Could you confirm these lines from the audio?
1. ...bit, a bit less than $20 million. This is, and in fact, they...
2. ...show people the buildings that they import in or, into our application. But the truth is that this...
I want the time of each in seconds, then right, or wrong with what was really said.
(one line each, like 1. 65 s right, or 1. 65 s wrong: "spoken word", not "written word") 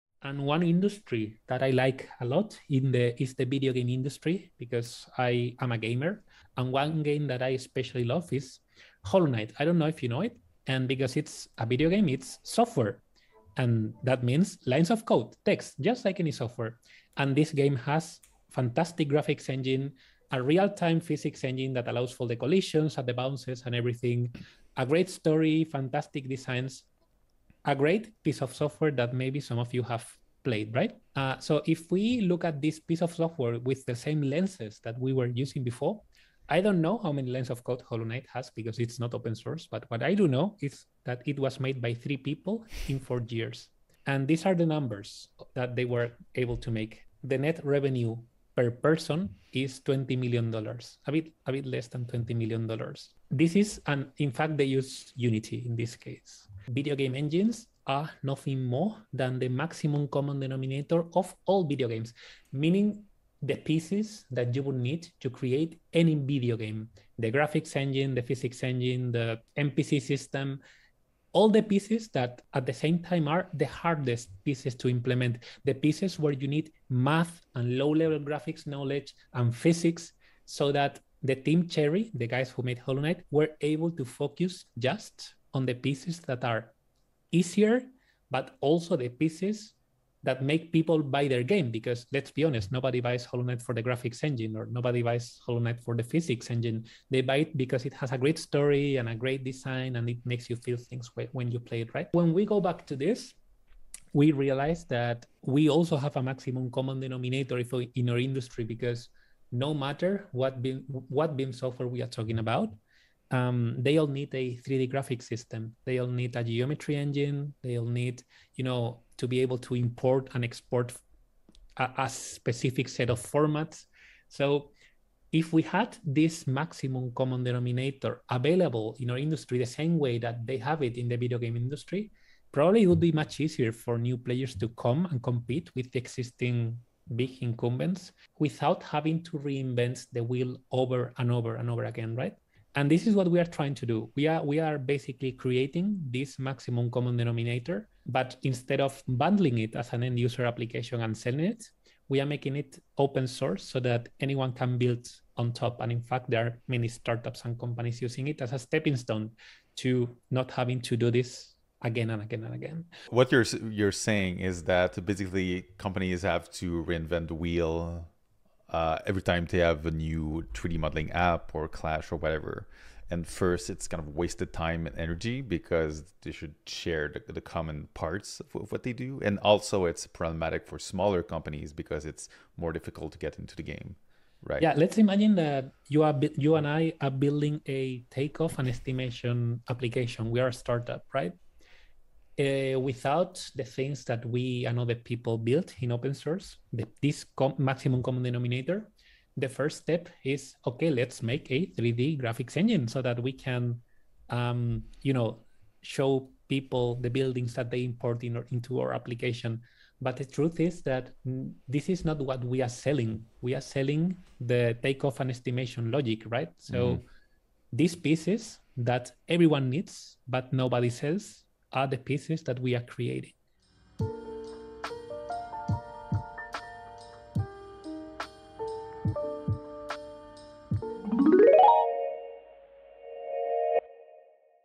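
1. 51 s right
2. 205 s right.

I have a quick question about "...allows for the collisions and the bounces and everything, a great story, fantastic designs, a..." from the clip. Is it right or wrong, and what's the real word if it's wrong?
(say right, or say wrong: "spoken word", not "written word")
right.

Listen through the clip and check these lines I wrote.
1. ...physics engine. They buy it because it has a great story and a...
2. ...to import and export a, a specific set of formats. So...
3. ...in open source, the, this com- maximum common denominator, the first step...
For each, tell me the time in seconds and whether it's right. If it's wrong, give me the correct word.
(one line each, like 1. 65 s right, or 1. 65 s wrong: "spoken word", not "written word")
1. 96 s right
2. 119 s right
3. 195 s right.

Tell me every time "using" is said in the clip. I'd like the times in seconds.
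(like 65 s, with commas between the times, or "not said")
35 s, 158 s.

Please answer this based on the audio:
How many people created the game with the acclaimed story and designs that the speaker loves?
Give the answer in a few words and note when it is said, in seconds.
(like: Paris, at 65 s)
3, at 41 s.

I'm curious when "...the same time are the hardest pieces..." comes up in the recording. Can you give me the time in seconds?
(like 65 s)
72 s.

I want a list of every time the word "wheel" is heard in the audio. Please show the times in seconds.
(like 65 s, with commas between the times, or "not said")
140 s, 167 s.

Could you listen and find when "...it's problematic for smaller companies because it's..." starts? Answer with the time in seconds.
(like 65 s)
179 s.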